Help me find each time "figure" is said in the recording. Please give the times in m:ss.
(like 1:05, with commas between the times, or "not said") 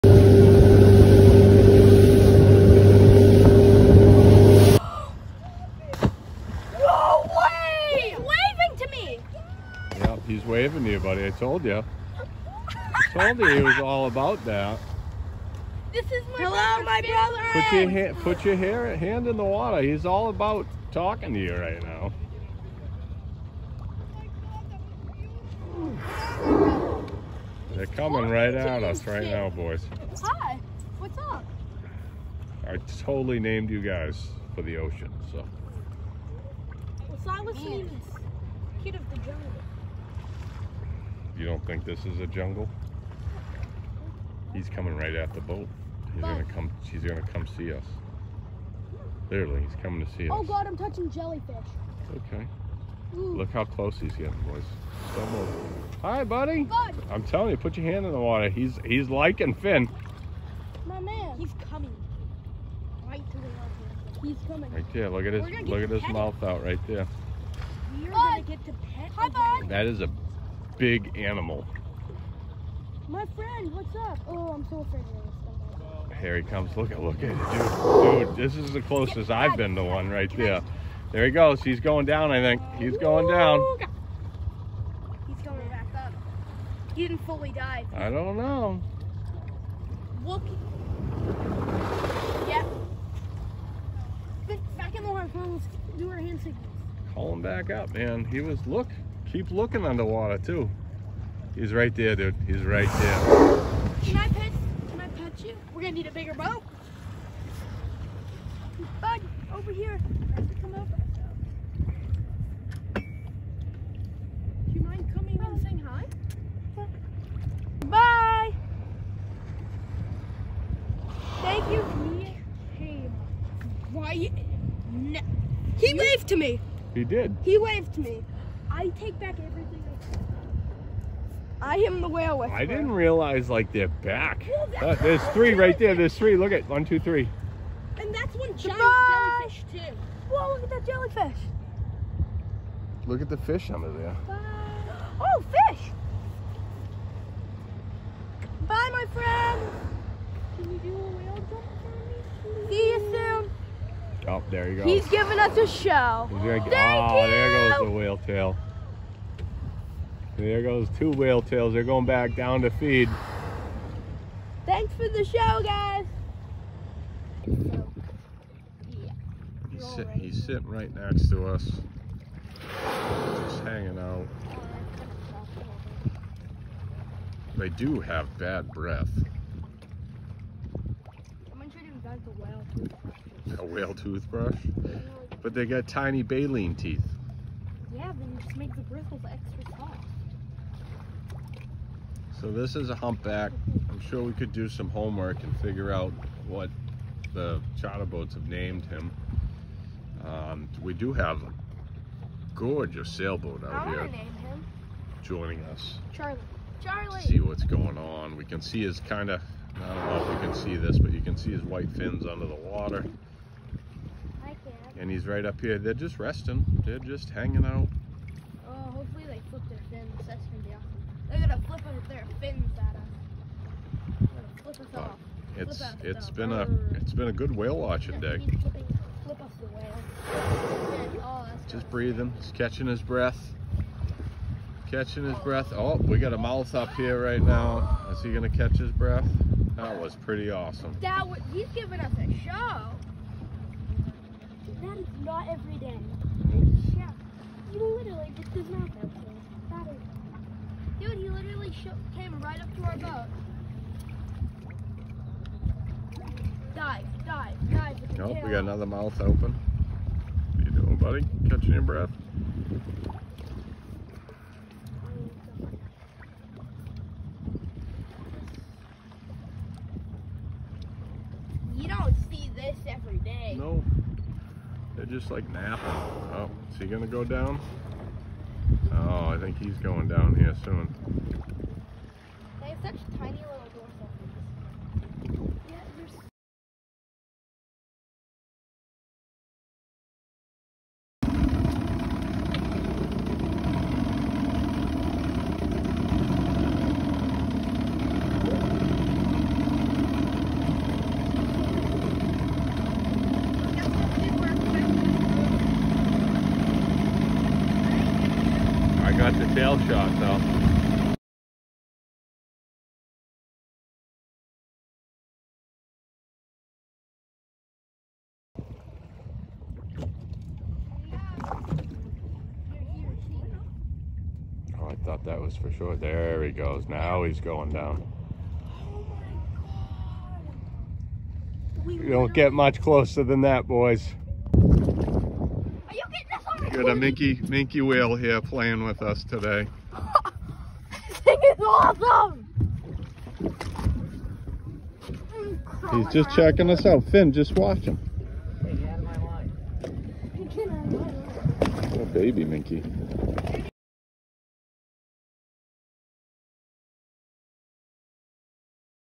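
3:15.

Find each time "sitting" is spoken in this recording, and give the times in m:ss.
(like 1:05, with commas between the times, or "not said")
2:50.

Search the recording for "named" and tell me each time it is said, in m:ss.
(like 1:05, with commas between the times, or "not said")
0:33, 3:18.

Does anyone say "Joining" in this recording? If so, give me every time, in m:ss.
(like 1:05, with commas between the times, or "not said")
3:25.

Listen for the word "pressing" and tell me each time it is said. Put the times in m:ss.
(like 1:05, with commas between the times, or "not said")
not said.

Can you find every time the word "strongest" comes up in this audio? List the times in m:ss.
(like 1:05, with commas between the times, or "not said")
not said.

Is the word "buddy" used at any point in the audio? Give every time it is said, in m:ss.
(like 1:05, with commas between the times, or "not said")
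0:10, 0:56, 4:20.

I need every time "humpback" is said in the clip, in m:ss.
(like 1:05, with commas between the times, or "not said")
3:12.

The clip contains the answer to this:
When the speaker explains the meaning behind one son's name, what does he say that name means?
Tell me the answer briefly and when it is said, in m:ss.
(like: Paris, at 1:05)
Kid of the jungle, at 0:38.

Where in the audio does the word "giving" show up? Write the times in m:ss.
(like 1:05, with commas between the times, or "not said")
2:35, 4:01.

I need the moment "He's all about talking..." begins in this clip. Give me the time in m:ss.
0:19.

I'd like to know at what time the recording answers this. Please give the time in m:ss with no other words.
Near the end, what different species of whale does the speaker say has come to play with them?
5:37.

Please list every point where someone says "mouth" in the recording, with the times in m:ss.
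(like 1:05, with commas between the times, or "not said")
1:06, 3:56, 4:18.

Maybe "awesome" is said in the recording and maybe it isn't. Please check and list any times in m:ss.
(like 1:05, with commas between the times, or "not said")
3:40, 4:00, 5:41.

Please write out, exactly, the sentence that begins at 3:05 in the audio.
But they got tiny baleen teeth.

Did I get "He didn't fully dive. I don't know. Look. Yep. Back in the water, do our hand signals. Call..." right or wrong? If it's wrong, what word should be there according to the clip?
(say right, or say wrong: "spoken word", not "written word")
right.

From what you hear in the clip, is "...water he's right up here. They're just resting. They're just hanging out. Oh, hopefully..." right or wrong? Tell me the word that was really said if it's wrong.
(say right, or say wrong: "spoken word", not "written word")
right.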